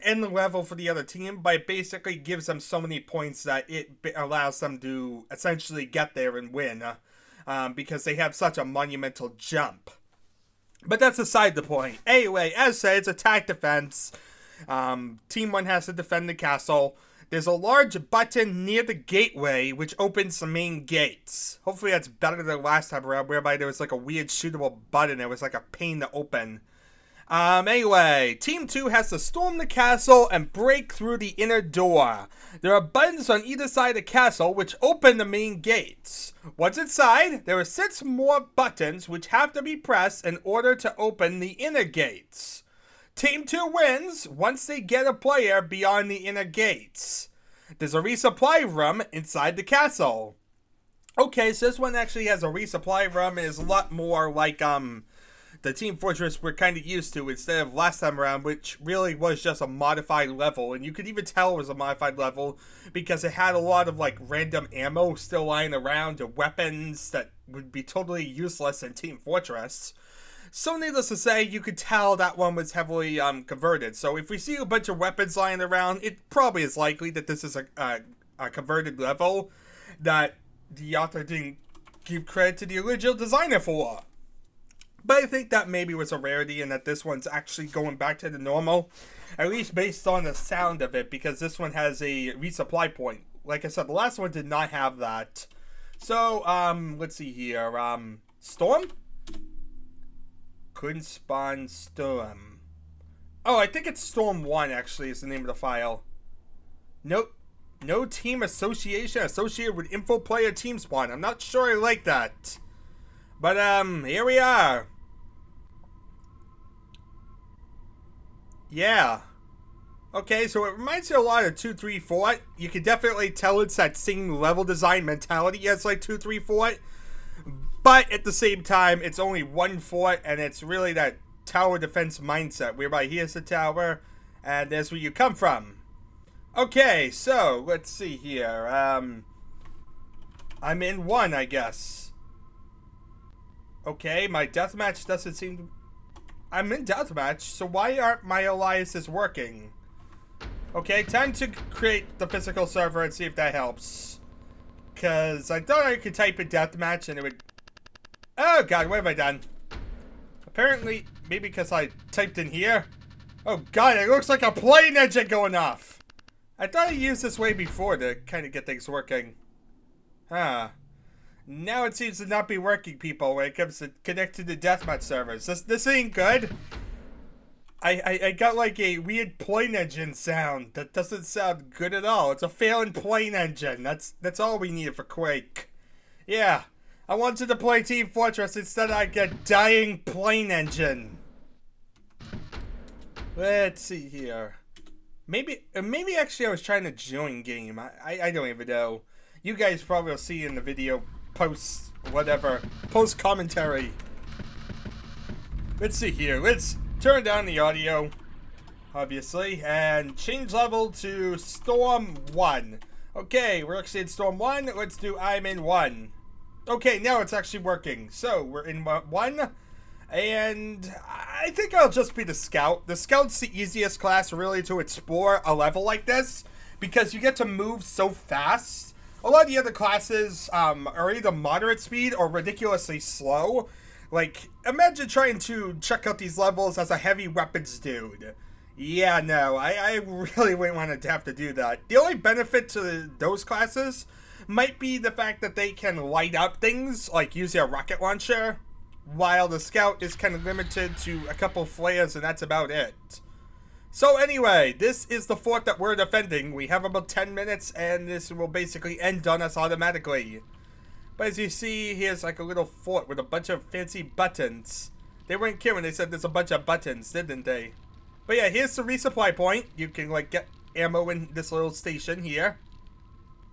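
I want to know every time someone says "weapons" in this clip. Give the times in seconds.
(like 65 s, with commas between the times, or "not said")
66 s, 74 s, 237 s.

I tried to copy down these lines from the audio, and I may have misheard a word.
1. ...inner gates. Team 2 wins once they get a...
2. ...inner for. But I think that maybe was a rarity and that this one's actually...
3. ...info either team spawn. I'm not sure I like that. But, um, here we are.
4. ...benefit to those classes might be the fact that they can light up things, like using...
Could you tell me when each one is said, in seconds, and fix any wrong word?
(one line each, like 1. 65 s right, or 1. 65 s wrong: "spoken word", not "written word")
1. 41 s right
2. 83 s wrong: "designer", not "inner"
3. 109 s wrong: "player", not "either"
4. 242 s right.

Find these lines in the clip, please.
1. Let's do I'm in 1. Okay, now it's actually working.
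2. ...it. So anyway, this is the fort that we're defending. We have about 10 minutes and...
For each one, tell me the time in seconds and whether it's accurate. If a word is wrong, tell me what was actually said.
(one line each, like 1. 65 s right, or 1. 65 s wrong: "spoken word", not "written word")
1. 214 s right
2. 252 s right.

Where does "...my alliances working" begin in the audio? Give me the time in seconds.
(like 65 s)
148 s.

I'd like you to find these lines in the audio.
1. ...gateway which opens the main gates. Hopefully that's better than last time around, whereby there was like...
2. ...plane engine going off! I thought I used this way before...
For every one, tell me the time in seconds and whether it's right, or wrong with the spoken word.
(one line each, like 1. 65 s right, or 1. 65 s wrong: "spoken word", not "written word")
1. 18 s right
2. 164 s right.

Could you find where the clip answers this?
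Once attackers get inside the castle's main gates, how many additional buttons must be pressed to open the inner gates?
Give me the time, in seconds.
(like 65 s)
37 s.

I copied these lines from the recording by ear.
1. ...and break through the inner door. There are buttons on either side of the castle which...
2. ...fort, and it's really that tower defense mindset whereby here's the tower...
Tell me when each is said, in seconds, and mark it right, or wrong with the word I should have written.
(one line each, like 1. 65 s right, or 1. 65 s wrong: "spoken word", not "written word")
1. 30 s right
2. 129 s right.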